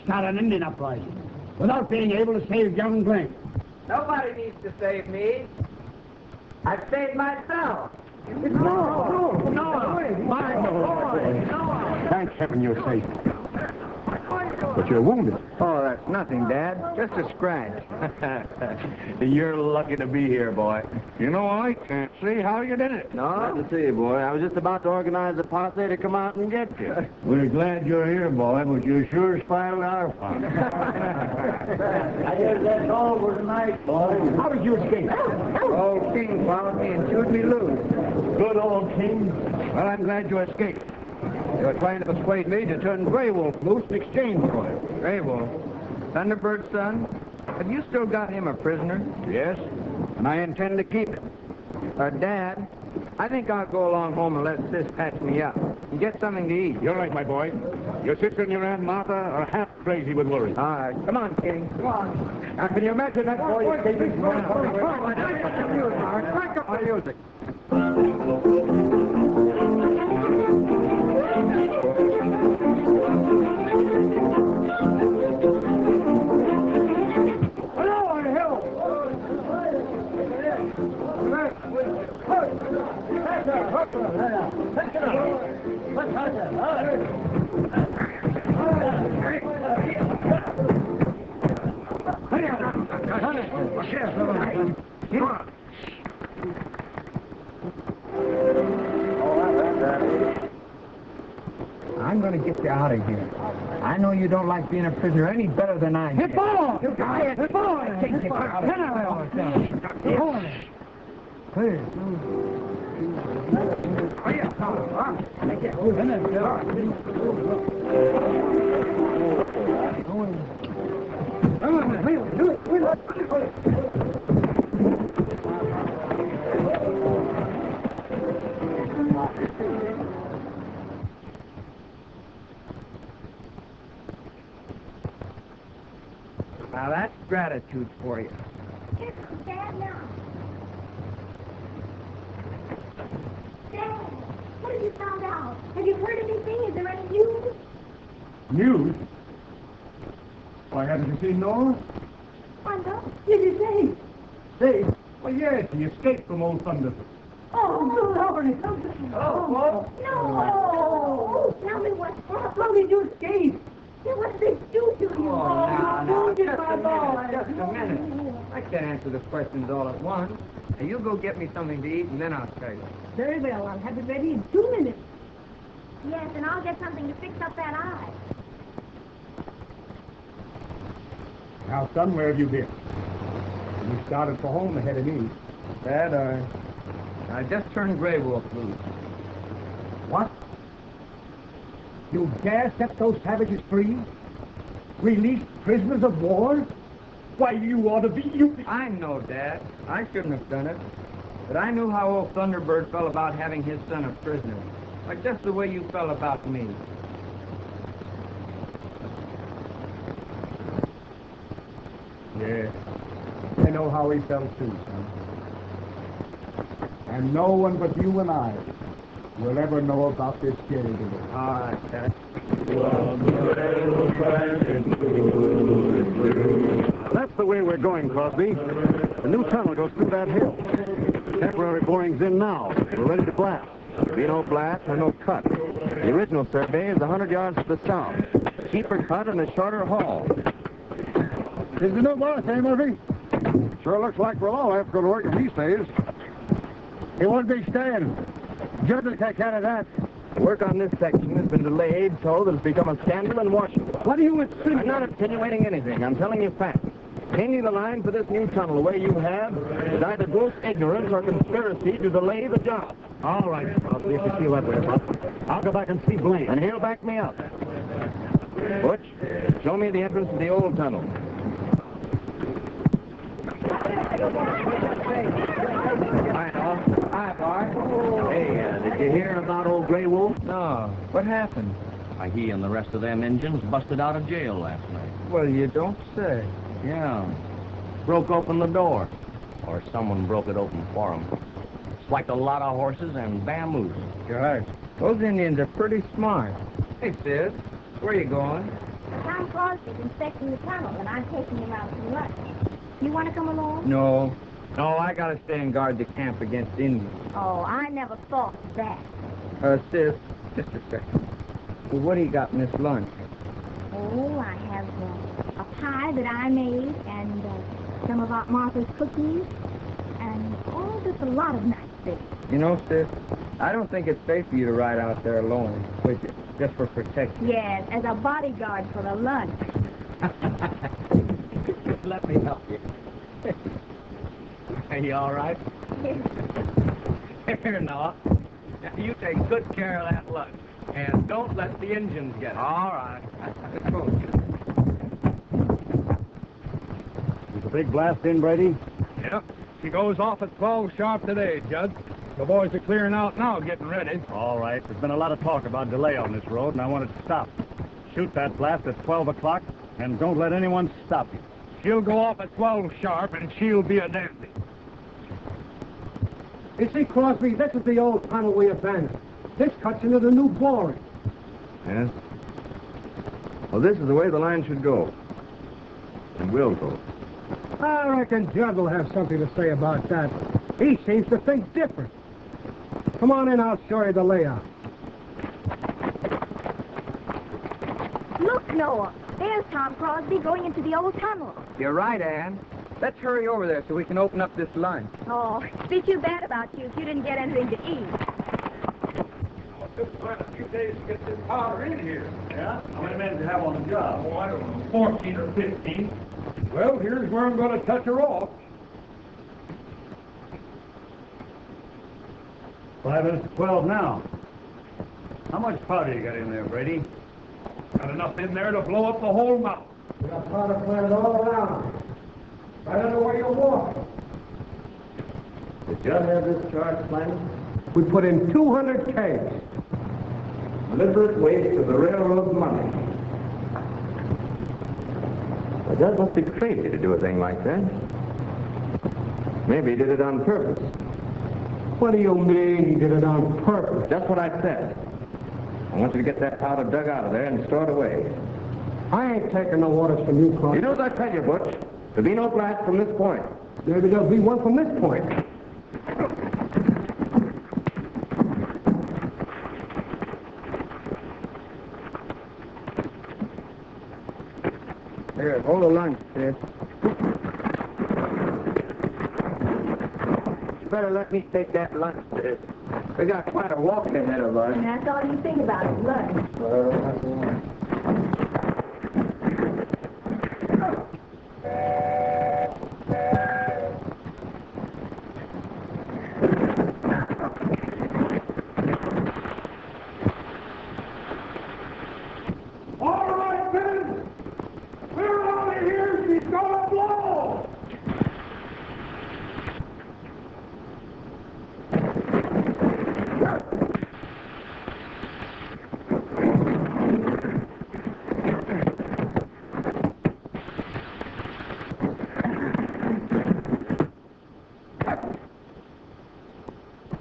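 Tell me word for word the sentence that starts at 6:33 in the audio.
Let's hurry over there so we can open up this lunch.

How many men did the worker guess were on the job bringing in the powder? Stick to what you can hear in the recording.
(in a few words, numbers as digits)
14 or 15.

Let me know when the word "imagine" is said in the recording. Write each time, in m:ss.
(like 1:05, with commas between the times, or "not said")
1:02.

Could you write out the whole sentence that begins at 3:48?
The new tunnel goes through that hill.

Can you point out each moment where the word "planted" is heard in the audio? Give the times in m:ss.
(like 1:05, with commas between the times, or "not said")
7:00, 7:07.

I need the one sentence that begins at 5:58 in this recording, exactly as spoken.
Shoot that blast at 12 o'clock, and don't let anyone stop you.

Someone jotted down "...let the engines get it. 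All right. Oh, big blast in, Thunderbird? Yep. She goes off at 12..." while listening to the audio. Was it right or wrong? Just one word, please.
wrong.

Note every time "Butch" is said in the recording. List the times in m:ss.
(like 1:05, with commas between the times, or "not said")
4:28, 7:31.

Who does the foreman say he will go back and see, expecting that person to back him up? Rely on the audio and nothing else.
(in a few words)
Blaine.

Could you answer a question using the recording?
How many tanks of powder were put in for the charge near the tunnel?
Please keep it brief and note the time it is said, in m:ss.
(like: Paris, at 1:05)
200, at 7:08.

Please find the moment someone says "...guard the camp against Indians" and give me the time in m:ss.
5:05.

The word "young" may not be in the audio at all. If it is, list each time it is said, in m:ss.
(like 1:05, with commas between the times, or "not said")
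0:02.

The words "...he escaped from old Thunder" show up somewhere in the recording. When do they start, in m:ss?
2:35.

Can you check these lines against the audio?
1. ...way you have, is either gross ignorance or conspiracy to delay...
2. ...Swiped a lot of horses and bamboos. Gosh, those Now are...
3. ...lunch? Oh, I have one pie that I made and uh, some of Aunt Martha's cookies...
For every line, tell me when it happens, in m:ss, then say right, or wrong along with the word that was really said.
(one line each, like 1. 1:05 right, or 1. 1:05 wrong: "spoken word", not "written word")
1. 4:18 right
2. 4:52 wrong: "Indians", not "Now"
3. 5:12 right.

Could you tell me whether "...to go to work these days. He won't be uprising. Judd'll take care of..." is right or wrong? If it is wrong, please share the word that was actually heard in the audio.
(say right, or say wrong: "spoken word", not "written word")
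wrong: "staying", not "uprising".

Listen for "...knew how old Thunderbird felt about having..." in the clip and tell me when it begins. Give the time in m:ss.
3:21.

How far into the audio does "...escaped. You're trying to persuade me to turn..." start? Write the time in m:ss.
0:40.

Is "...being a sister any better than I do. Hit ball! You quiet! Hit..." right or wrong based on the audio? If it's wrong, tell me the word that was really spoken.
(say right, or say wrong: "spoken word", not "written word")
wrong: "prisoner", not "sister".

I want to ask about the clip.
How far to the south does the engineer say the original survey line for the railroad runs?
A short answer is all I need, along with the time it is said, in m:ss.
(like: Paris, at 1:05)
100 yards, at 3:56.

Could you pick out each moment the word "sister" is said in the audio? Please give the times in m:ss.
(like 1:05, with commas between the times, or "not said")
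0:58.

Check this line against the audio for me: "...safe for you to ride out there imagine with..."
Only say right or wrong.
wrong.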